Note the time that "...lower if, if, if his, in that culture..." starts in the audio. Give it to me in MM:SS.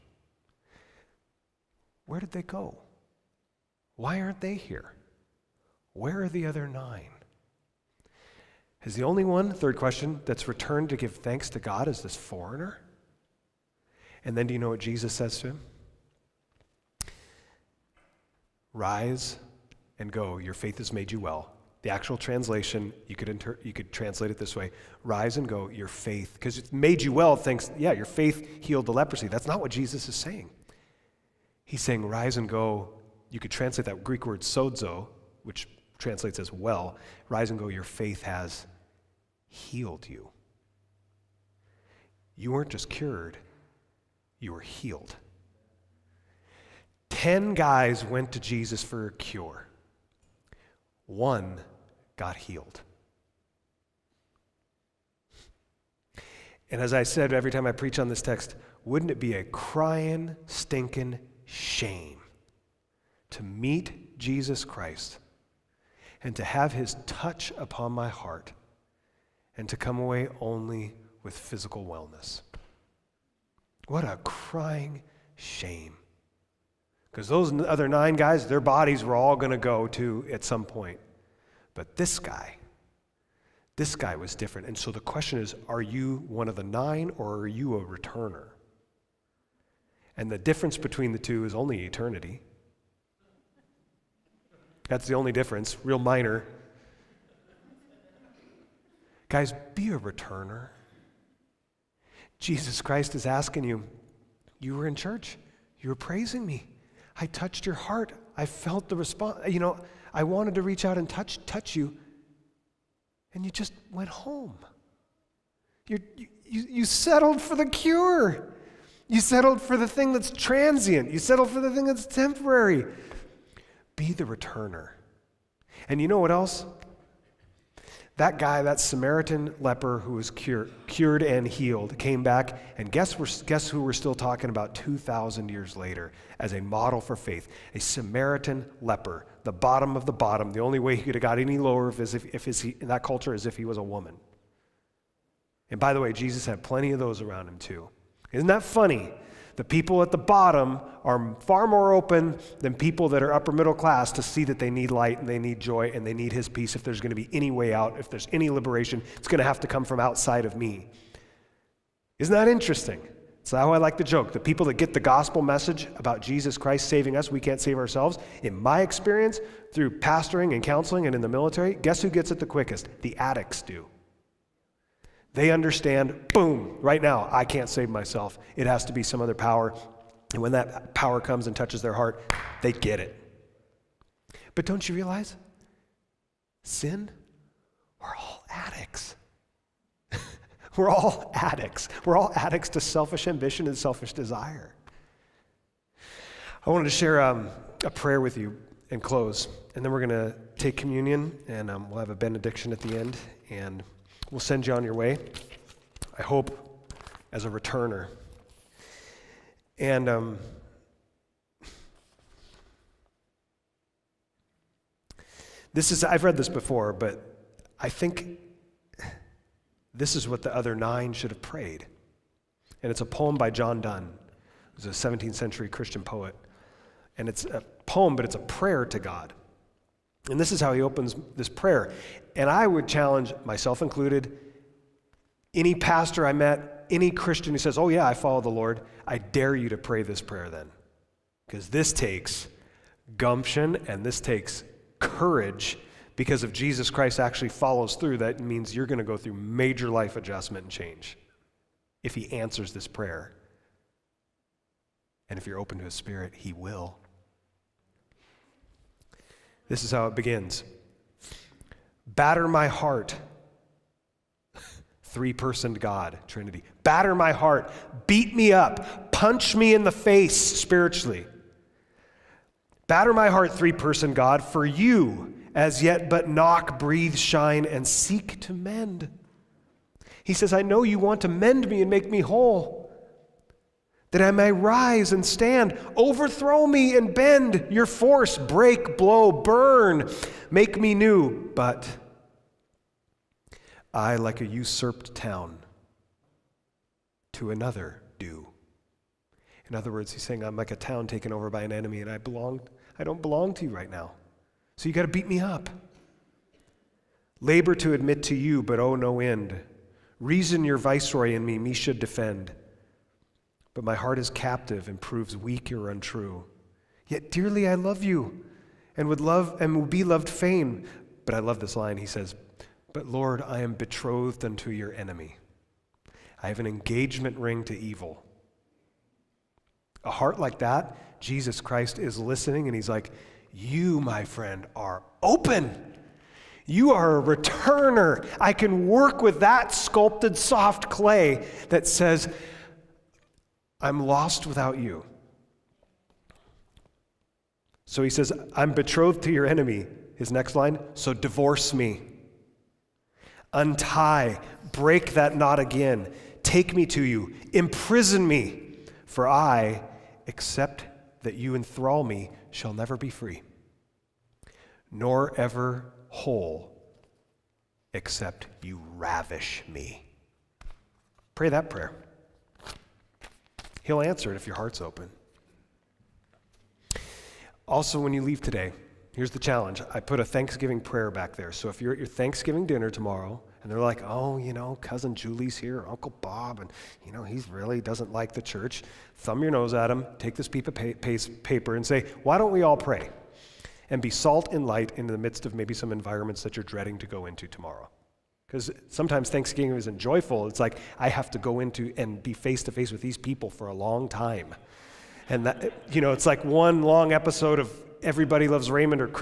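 02:21.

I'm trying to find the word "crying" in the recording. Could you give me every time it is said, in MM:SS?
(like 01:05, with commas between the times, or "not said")
00:59, 01:14.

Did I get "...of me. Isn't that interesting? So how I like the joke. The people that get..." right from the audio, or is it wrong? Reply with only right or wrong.
right.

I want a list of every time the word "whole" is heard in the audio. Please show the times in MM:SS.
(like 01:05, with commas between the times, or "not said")
04:42, 06:06.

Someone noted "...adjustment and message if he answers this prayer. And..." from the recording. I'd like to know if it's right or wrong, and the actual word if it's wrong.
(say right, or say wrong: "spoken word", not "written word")
wrong: "change", not "message".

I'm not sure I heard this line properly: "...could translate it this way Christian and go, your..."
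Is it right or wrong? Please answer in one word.
wrong.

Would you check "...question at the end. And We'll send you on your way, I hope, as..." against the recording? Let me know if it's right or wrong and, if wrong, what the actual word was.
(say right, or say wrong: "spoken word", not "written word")
wrong: "benediction", not "question".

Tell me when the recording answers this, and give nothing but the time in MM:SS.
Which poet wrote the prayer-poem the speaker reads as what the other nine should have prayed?
03:43.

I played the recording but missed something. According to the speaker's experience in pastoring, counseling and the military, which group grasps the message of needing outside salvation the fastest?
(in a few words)
The addicts.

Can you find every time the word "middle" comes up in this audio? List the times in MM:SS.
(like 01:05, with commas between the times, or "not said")
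02:33.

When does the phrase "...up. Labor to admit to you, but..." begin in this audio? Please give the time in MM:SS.
05:05.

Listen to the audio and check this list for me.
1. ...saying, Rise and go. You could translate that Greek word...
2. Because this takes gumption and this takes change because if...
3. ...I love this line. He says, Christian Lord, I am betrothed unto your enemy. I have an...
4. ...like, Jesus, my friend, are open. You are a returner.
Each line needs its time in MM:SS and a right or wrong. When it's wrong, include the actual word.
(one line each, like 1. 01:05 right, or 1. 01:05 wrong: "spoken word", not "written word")
1. 00:31 right
2. 04:01 wrong: "courage", not "change"
3. 05:21 wrong: "But", not "Christian"
4. 05:32 wrong: "You", not "Jesus".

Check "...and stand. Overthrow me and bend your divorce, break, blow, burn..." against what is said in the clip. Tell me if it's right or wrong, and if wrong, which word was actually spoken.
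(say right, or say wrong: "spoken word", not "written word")
wrong: "force", not "divorce".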